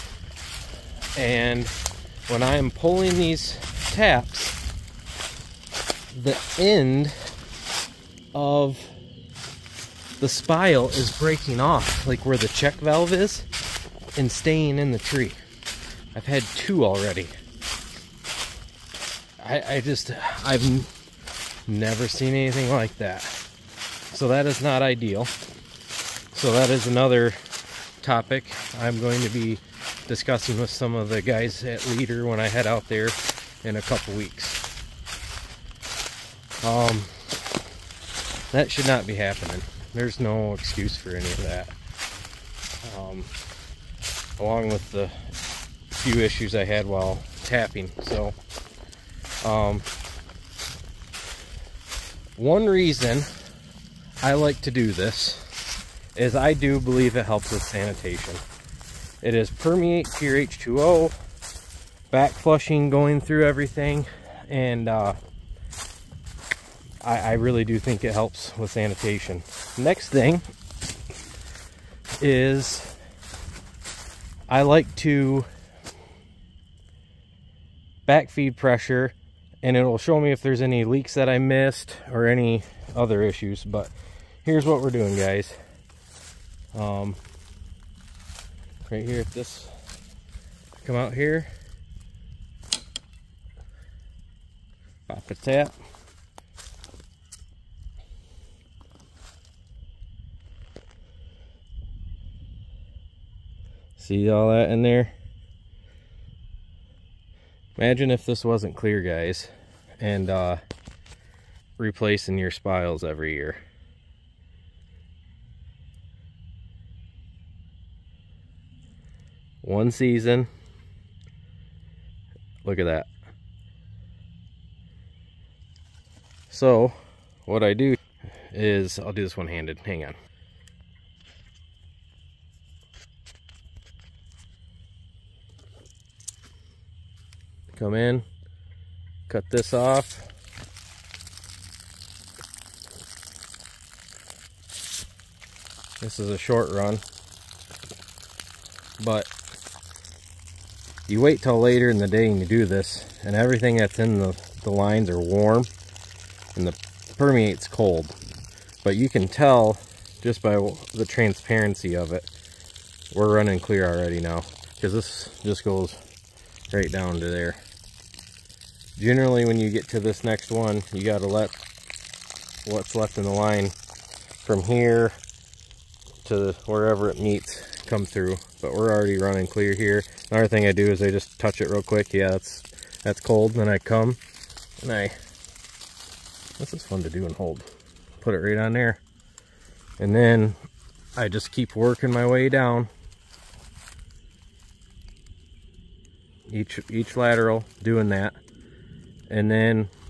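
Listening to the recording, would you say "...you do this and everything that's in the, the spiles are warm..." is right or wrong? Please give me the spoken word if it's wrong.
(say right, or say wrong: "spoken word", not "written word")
wrong: "lines", not "spiles".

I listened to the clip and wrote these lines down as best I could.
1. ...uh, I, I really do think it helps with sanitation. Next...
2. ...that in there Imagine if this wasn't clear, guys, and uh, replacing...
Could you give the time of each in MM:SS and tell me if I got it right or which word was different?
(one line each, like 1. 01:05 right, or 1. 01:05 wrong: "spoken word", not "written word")
1. 01:04 right
2. 01:44 right.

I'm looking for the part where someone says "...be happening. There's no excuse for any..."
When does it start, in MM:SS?
00:39.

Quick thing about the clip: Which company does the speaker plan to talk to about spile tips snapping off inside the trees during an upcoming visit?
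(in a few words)
Leader.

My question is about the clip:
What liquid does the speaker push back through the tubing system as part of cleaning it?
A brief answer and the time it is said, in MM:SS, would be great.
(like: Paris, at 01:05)
Permeate, at 00:59.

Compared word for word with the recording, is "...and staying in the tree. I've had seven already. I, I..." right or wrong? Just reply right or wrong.
wrong.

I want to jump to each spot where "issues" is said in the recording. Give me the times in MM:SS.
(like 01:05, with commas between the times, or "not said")
00:46, 01:23.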